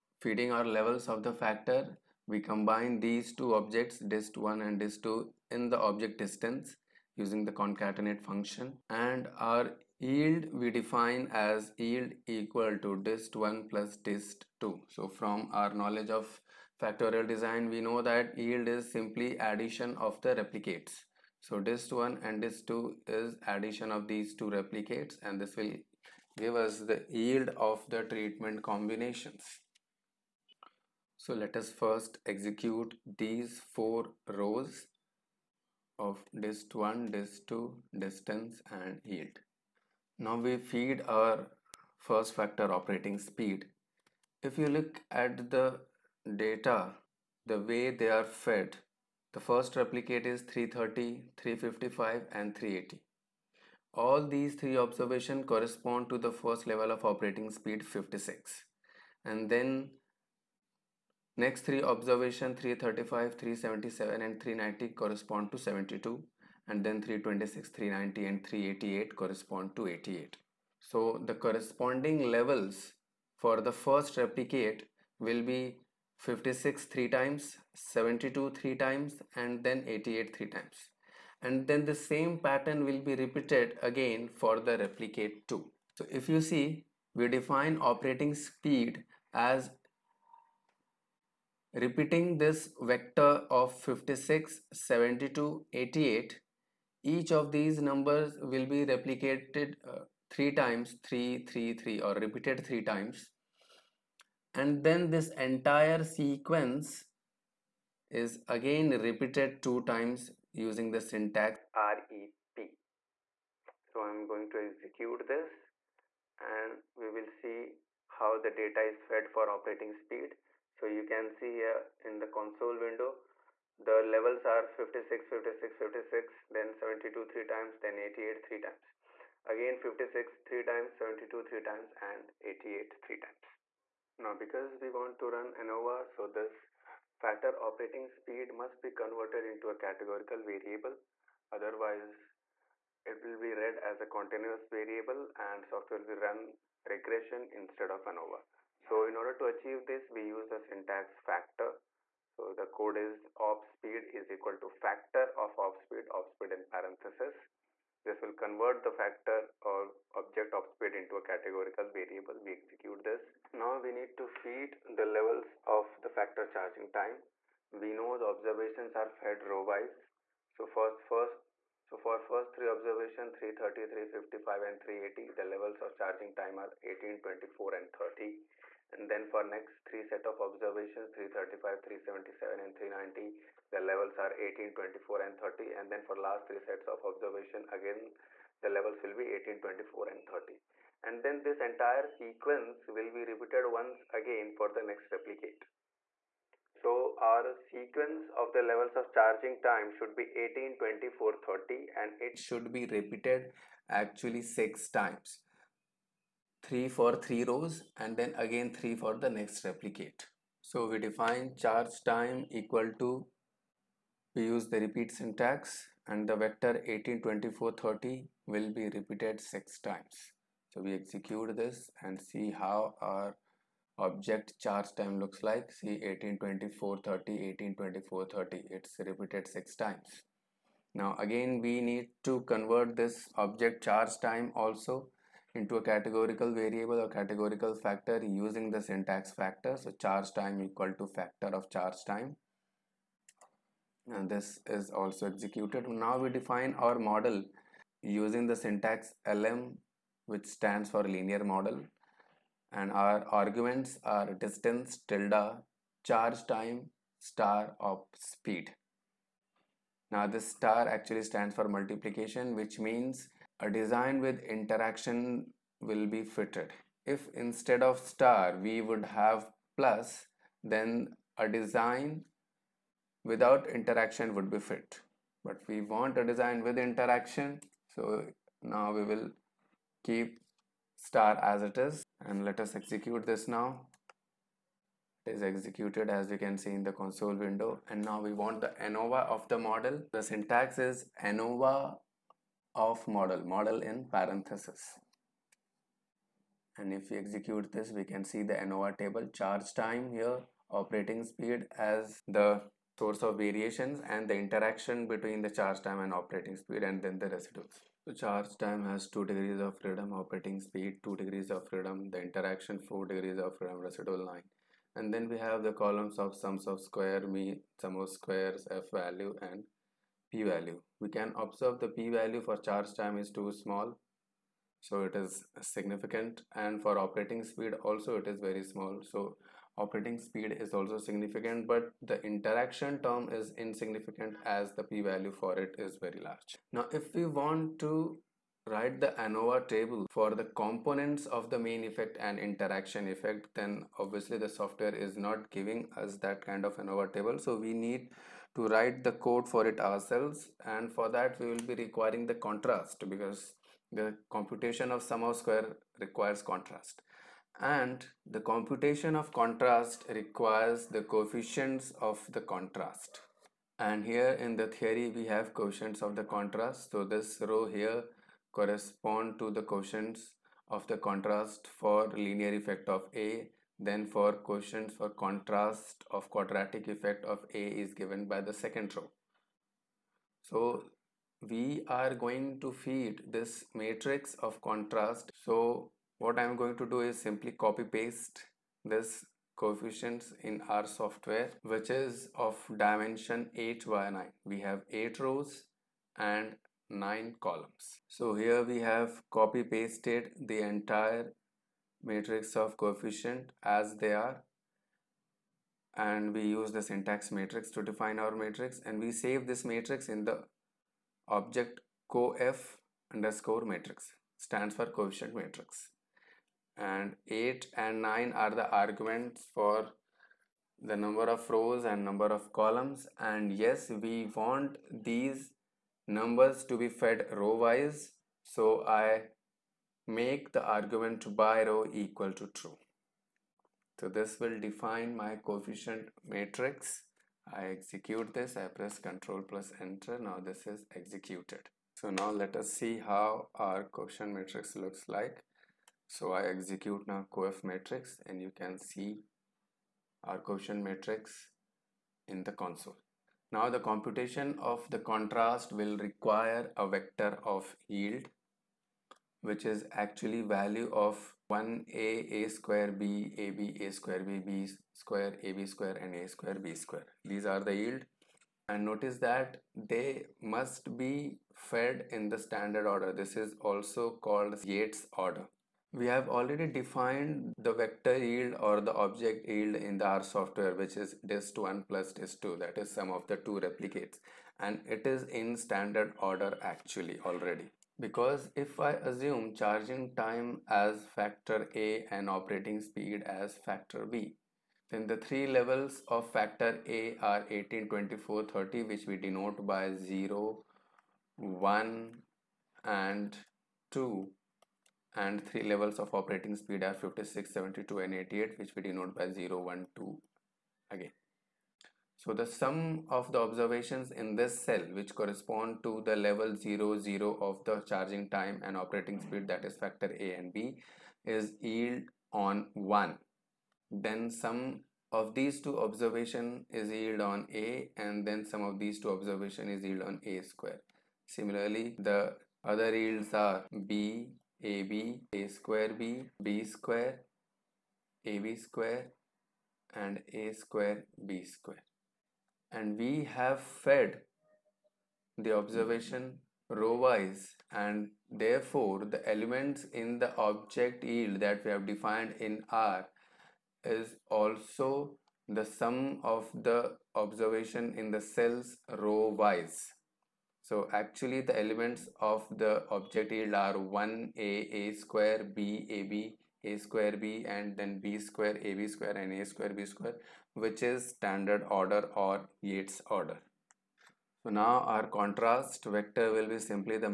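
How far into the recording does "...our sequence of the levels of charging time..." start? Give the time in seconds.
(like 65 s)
197 s.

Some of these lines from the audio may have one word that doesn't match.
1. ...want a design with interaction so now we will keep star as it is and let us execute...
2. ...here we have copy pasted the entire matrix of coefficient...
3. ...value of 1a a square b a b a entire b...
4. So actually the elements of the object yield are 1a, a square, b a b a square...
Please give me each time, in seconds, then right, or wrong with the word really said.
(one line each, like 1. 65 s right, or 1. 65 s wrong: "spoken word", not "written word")
1. 275 s right
2. 398 s right
3. 460 s wrong: "square", not "entire"
4. 560 s right.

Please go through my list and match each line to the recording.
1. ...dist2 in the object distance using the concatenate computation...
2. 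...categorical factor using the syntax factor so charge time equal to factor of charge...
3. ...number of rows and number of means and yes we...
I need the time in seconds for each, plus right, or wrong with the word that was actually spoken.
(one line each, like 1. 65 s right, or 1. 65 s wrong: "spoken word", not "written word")
1. 4 s wrong: "function", not "computation"
2. 237 s right
3. 420 s wrong: "columns", not "means".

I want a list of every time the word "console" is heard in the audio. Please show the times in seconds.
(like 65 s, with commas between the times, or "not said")
122 s, 286 s, 452 s.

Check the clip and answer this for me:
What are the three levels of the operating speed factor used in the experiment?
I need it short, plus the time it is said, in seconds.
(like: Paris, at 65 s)
56, 72, 88, at 93 s.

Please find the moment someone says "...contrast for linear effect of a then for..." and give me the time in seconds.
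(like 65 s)
370 s.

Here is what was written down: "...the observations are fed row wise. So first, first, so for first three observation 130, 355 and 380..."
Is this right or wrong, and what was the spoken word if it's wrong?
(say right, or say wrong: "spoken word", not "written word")
wrong: "330", not "130".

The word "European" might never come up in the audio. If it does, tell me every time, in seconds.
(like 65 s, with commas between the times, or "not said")
not said.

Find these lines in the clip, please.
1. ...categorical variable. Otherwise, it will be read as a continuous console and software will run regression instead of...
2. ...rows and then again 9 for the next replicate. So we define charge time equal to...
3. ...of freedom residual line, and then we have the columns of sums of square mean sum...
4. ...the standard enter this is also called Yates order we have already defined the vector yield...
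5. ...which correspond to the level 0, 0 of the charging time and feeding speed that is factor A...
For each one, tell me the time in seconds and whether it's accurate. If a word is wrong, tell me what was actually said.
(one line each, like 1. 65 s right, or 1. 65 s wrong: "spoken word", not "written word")
1. 139 s wrong: "variable", not "console"
2. 207 s wrong: "3", not "9"
3. 313 s right
4. 472 s wrong: "order", not "enter"
5. 514 s wrong: "operating", not "feeding".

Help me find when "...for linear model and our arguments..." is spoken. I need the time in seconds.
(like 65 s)
250 s.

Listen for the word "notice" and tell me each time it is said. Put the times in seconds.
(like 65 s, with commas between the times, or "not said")
468 s.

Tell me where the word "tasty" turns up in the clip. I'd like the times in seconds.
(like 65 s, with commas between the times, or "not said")
not said.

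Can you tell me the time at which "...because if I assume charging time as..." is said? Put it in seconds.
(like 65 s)
488 s.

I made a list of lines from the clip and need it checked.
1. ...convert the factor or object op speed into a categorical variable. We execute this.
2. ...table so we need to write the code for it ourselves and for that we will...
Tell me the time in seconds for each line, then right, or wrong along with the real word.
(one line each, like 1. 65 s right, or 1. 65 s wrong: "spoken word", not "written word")
1. 158 s right
2. 347 s right.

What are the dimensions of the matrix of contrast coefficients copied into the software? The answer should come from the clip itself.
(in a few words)
8 by 9.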